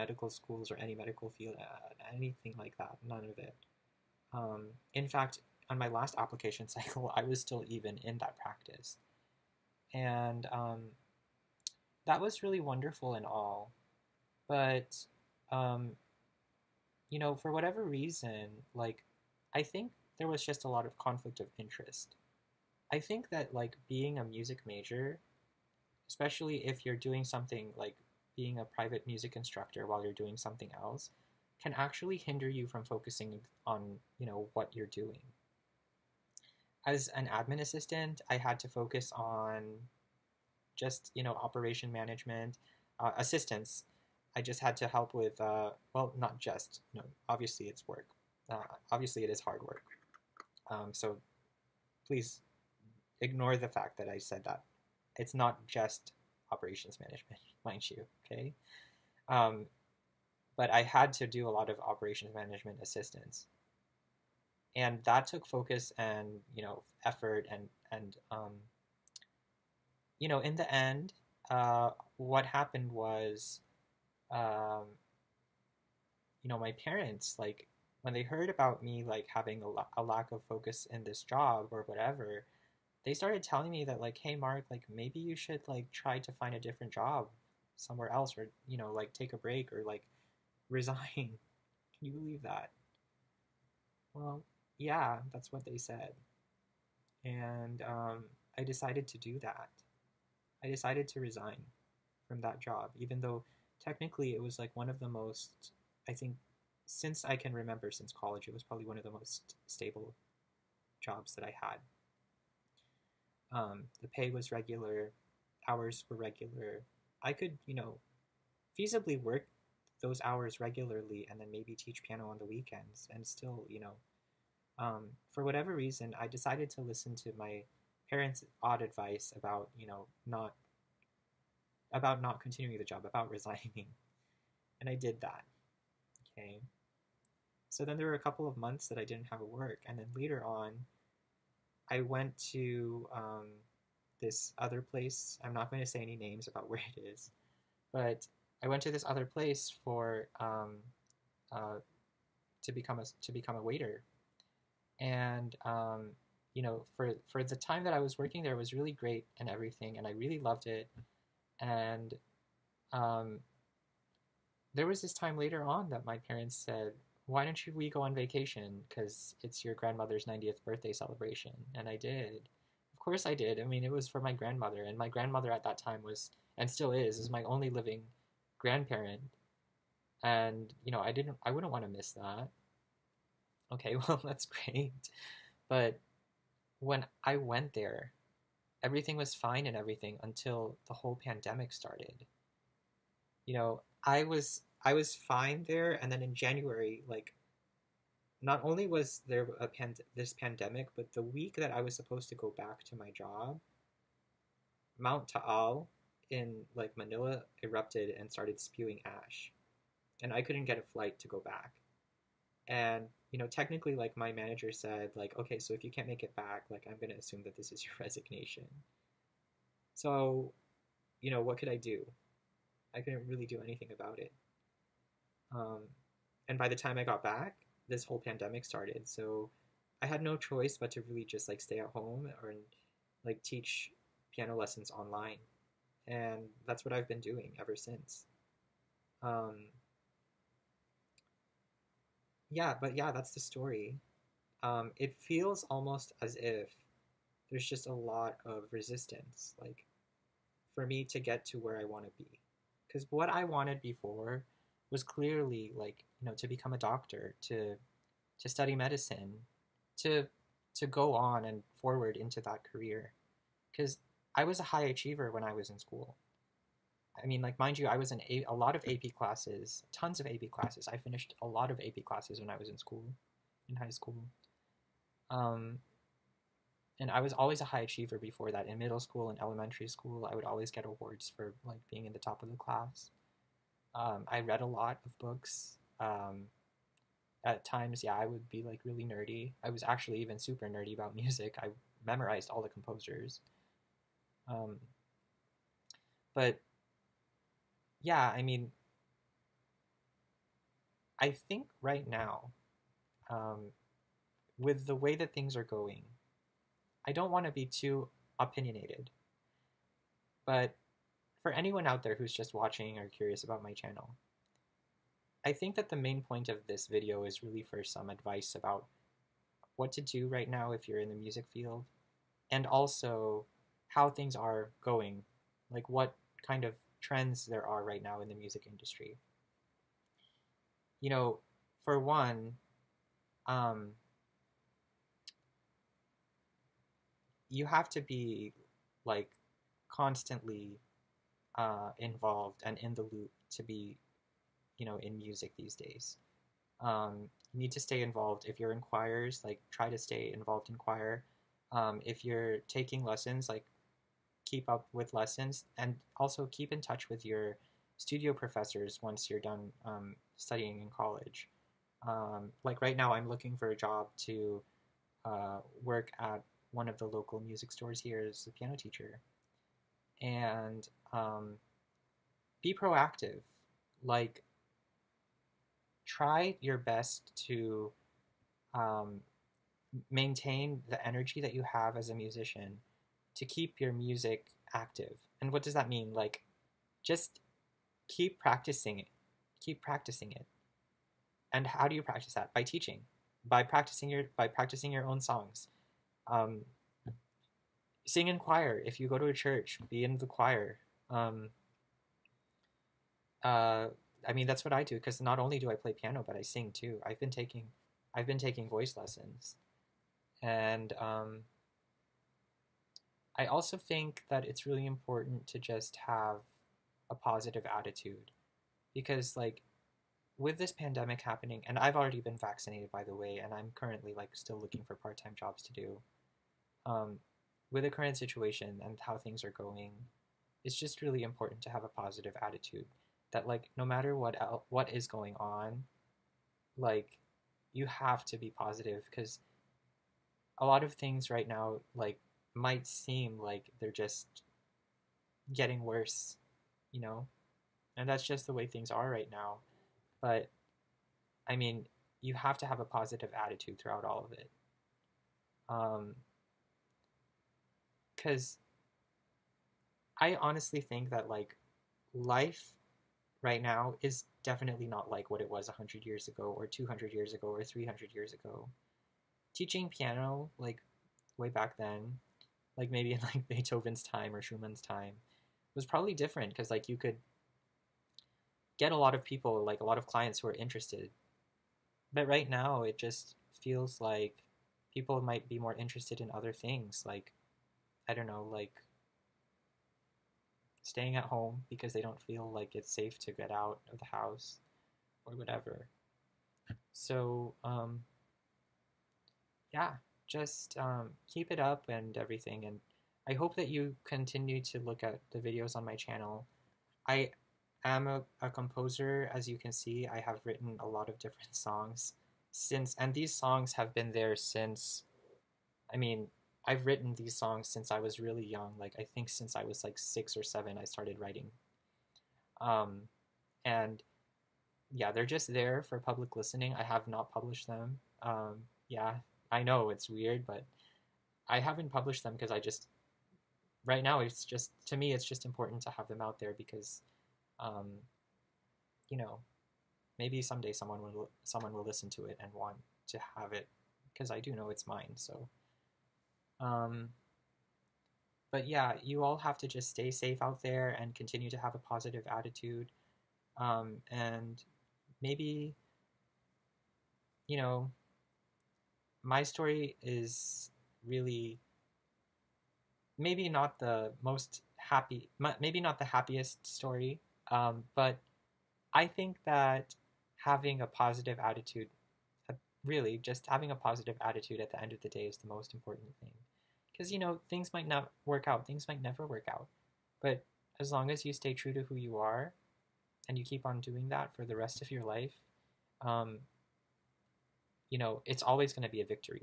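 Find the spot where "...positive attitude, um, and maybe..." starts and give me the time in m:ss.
9:11.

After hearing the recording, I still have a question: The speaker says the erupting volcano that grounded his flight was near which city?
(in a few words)
Manila.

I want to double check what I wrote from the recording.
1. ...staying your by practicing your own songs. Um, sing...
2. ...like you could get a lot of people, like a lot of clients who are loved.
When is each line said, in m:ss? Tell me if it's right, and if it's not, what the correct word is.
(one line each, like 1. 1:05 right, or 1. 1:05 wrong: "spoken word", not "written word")
1. 6:33 wrong: "practicing", not "staying"
2. 7:56 wrong: "interested", not "loved".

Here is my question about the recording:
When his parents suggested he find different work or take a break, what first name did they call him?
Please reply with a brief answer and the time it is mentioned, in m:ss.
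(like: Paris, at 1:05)
Marc, at 1:24.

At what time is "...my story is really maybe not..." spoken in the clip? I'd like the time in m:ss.
9:19.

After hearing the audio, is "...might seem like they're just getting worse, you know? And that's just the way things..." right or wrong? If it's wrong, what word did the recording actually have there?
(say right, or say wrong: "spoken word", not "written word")
right.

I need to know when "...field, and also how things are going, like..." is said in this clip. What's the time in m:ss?
5:21.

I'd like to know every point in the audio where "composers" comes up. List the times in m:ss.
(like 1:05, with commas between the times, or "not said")
4:52, 8:28.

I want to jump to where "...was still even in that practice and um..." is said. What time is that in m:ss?
0:07.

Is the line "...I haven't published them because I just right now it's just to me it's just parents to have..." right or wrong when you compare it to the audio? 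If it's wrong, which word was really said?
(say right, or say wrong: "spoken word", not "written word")
wrong: "important", not "parents".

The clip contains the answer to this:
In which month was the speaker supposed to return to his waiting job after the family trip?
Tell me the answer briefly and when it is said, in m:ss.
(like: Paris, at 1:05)
January, at 3:16.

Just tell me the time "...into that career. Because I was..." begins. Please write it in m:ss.
4:22.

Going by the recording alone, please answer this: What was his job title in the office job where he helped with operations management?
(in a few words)
admin assistant.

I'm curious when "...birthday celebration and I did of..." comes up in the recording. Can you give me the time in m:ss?
2:50.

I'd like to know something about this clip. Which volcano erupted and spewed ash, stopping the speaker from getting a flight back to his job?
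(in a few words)
Mount Taal.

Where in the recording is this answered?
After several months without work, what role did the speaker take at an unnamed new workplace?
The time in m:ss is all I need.
2:33.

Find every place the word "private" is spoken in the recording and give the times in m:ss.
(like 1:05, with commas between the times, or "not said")
0:28.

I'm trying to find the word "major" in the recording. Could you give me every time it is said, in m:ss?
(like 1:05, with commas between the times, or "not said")
0:24.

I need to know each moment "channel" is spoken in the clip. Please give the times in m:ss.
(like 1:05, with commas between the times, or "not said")
5:13, 8:25.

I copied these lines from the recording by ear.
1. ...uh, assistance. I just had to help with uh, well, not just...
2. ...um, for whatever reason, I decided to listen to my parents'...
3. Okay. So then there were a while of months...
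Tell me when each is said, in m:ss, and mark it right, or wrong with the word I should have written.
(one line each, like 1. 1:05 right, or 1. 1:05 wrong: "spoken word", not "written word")
1. 0:42 right
2. 2:04 right
3. 2:16 wrong: "couple", not "while".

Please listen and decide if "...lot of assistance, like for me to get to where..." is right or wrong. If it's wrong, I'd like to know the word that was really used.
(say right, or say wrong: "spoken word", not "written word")
wrong: "resistance", not "assistance".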